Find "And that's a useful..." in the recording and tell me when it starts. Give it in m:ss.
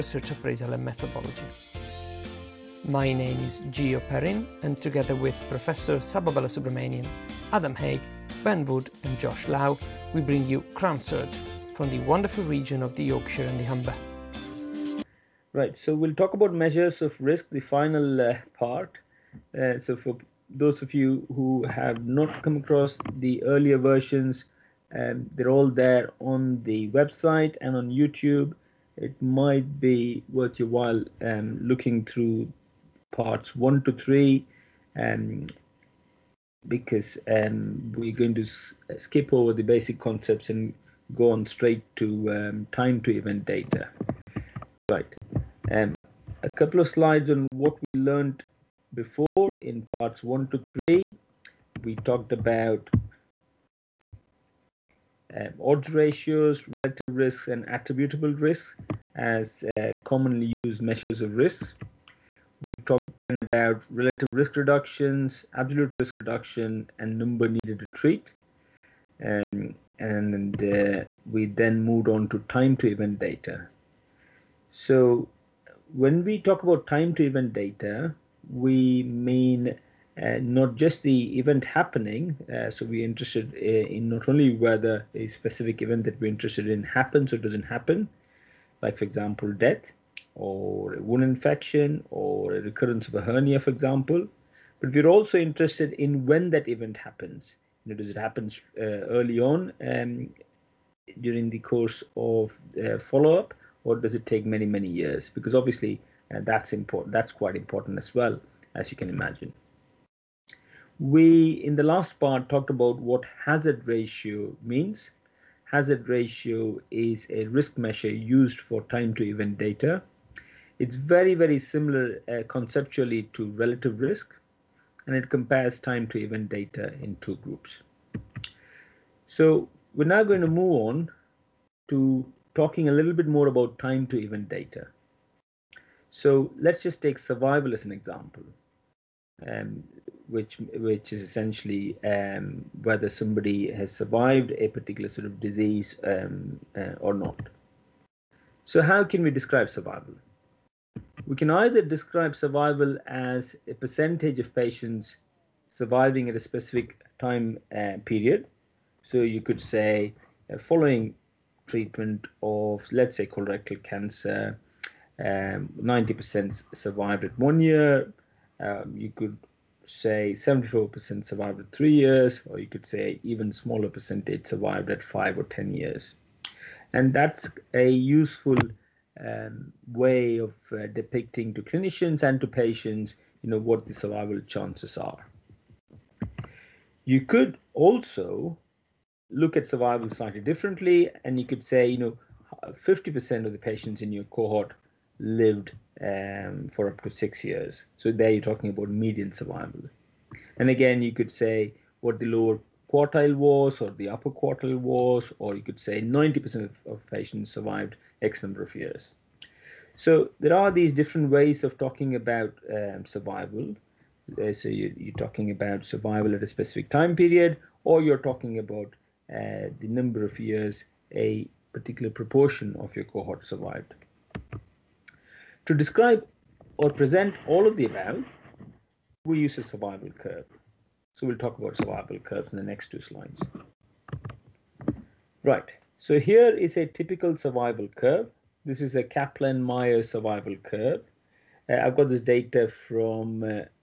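2:56.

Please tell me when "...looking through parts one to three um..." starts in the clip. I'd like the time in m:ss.
0:31.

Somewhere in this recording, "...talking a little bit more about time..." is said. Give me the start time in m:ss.
2:12.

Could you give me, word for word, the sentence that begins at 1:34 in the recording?
But we're also interested in when that event happens.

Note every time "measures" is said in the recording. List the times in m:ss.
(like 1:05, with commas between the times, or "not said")
0:16, 1:00, 1:57.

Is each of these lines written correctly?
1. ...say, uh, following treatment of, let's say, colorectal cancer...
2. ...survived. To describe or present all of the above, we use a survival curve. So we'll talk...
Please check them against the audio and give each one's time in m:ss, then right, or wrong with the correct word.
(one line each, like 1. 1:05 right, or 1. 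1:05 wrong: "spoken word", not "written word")
1. 2:39 right
2. 3:43 right.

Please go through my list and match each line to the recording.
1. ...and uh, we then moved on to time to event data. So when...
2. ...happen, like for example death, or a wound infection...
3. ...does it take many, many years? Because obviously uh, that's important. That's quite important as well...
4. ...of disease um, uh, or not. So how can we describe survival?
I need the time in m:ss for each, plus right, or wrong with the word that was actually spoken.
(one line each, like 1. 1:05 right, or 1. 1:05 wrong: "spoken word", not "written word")
1. 1:09 right
2. 1:27 right
3. 1:43 right
4. 2:25 right.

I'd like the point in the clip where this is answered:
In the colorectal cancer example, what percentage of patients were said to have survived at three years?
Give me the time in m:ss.
2:50.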